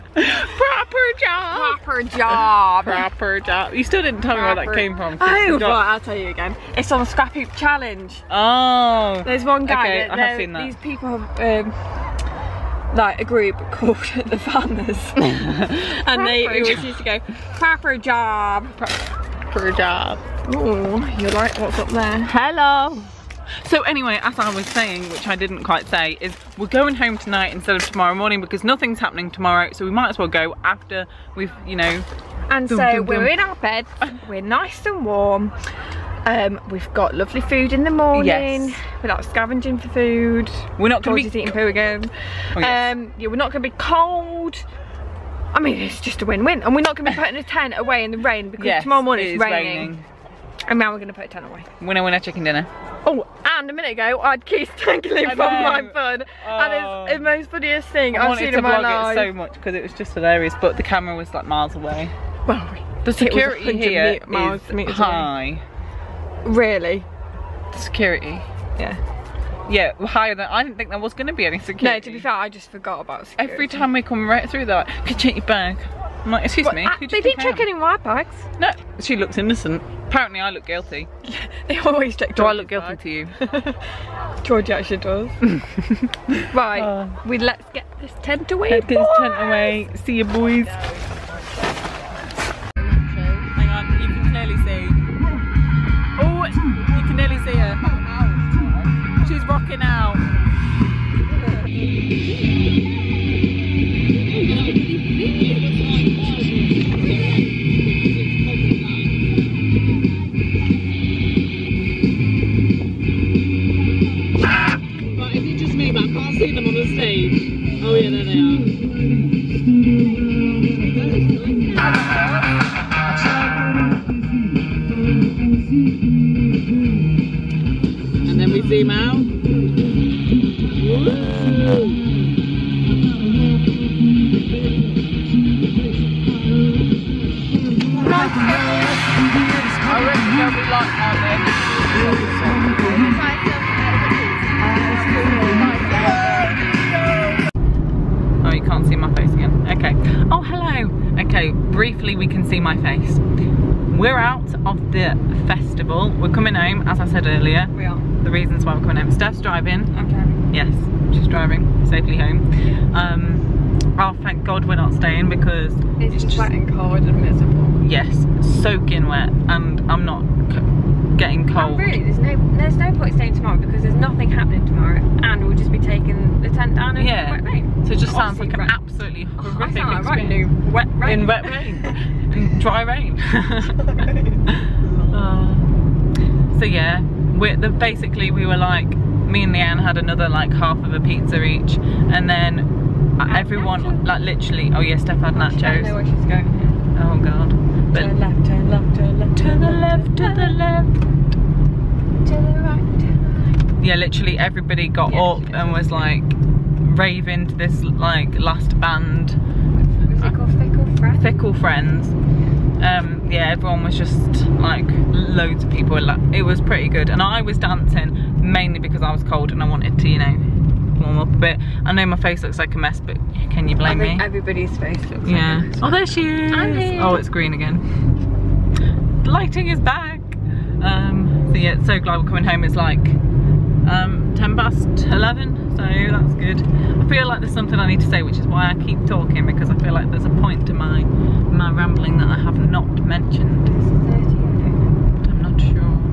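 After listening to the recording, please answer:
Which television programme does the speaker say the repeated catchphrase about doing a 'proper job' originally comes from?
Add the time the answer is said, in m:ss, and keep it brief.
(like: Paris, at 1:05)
Scrapheap Challenge, at 0:07.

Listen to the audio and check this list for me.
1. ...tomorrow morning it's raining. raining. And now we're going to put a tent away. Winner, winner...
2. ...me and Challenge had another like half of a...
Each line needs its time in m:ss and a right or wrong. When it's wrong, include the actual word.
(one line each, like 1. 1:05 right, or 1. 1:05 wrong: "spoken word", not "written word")
1. 0:48 right
2. 3:09 wrong: "Leanne", not "Challenge".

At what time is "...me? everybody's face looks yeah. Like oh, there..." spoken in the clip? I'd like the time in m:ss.
3:43.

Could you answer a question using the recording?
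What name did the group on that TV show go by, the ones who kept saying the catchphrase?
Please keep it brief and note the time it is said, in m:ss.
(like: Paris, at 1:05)
the farmers, at 0:14.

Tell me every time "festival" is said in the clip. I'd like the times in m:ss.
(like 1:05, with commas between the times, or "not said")
2:35.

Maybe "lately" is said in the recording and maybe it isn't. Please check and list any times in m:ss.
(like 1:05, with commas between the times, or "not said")
not said.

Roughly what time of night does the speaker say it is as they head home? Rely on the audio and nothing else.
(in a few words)
10 past 11.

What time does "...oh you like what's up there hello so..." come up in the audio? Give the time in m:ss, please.
0:20.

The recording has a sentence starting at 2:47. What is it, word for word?
Yes, soaking wet, and I'm not getting cold.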